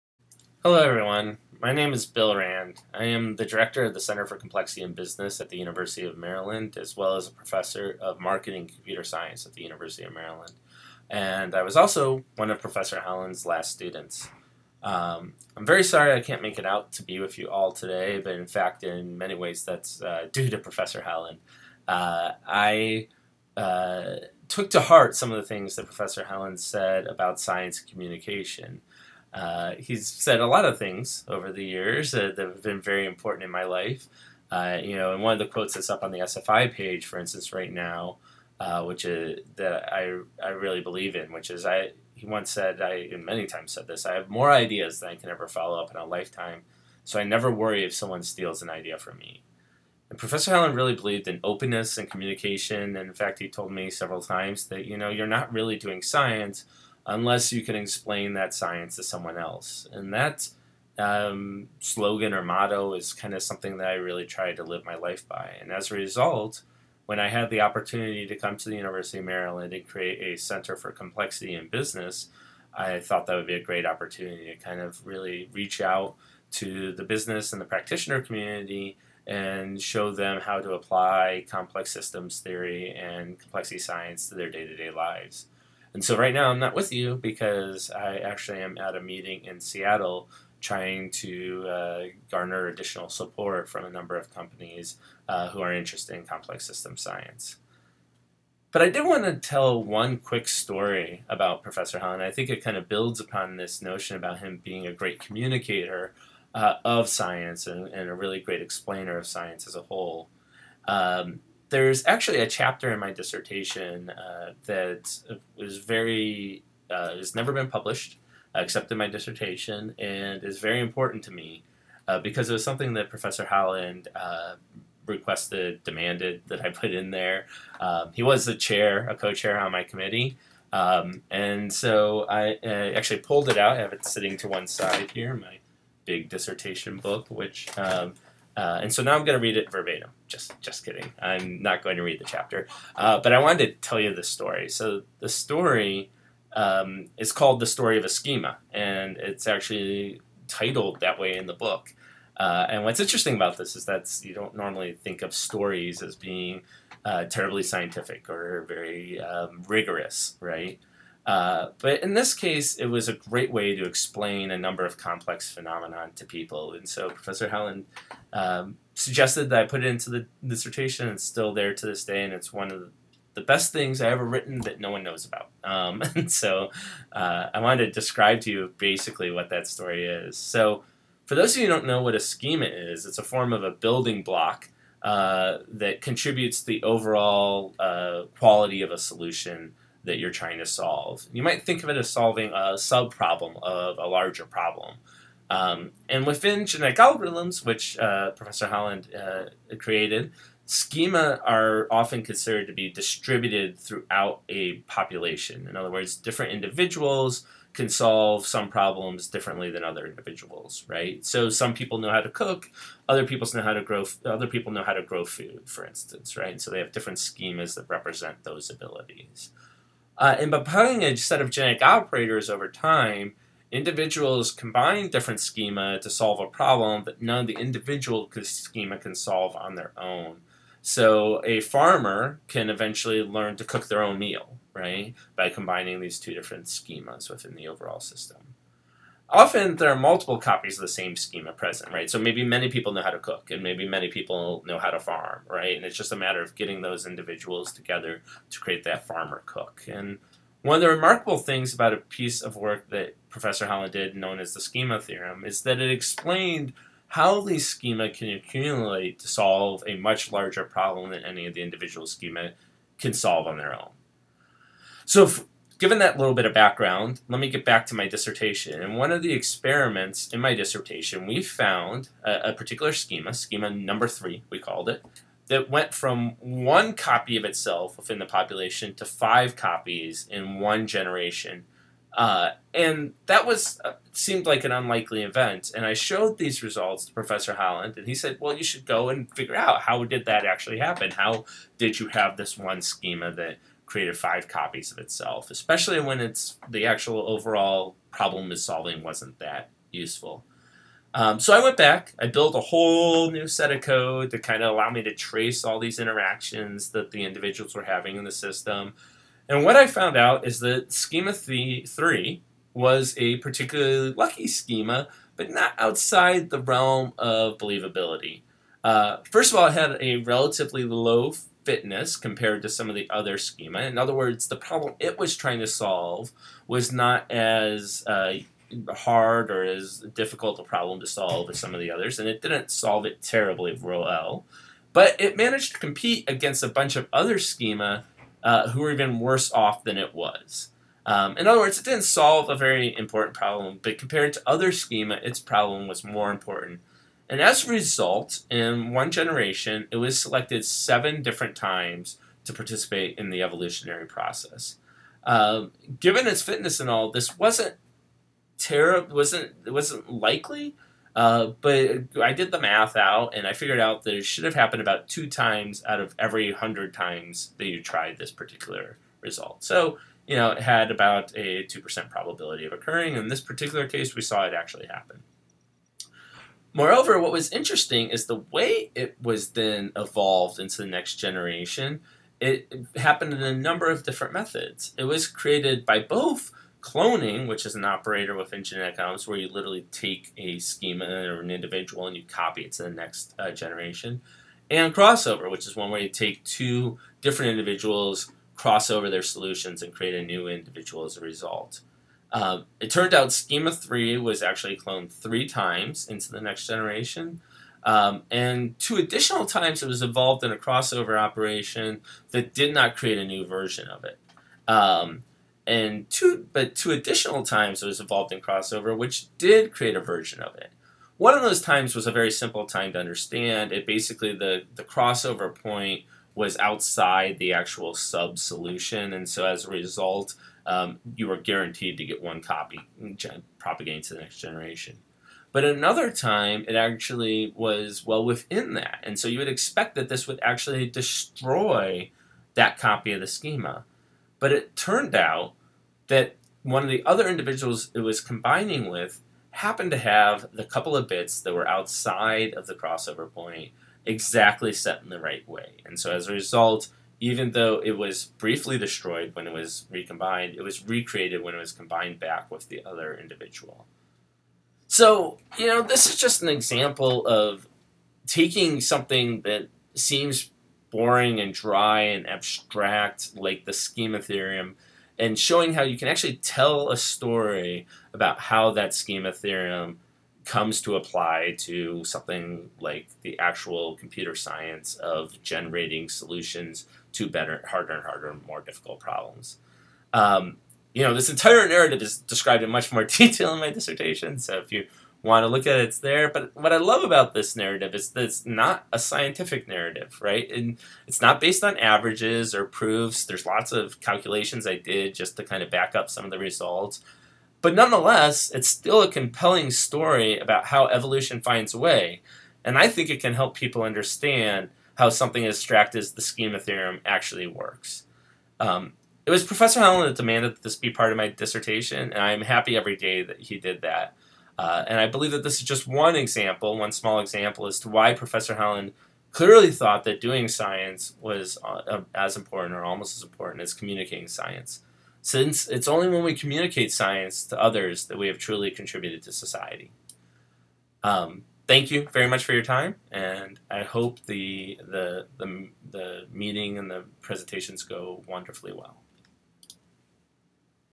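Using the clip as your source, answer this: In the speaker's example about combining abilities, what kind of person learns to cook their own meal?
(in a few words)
A farmer.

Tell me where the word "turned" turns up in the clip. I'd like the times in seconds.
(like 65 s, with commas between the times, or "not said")
402 s, 444 s.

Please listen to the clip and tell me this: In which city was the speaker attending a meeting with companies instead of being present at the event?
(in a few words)
Seattle.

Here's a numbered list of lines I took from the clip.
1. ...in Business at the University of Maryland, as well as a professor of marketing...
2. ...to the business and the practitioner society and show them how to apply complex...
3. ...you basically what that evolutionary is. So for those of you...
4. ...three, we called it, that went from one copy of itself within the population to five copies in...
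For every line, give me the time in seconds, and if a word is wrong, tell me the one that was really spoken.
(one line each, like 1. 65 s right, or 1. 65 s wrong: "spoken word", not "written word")
1. 4 s right
2. 76 s wrong: "community", not "society"
3. 178 s wrong: "story", not "evolutionary"
4. 274 s right.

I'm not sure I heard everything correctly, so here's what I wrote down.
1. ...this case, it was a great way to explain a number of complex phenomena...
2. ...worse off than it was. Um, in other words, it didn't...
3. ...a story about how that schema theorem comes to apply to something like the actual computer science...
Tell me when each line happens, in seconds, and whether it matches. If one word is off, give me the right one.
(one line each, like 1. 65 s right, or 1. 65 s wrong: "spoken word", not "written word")
1. 162 s right
2. 339 s right
3. 476 s right.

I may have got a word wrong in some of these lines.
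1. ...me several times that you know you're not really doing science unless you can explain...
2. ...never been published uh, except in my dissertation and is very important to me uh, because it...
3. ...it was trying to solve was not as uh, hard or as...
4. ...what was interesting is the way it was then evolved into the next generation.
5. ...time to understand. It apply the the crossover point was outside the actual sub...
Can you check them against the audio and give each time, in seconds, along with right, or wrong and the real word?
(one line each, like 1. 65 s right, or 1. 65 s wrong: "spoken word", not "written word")
1. 53 s right
2. 117 s right
3. 324 s right
4. 377 s right
5. 422 s wrong: "basically", not "apply".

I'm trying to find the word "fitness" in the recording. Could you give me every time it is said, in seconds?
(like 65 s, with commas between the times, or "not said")
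321 s, 356 s.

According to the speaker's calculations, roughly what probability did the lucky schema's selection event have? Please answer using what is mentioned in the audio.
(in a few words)
2 percent.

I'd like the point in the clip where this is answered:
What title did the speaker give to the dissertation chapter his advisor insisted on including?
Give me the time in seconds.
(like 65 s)
147 s.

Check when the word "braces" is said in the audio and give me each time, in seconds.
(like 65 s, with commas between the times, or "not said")
not said.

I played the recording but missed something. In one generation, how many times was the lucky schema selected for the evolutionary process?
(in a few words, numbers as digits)
7.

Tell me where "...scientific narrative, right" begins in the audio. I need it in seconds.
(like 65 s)
498 s.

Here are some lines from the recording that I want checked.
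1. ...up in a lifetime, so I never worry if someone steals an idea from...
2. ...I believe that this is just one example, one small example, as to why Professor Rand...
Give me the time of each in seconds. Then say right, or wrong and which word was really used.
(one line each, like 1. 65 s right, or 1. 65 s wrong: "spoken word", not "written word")
1. 45 s right
2. 524 s wrong: "Holland", not "Rand".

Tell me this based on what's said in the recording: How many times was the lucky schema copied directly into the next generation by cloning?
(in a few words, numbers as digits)
3.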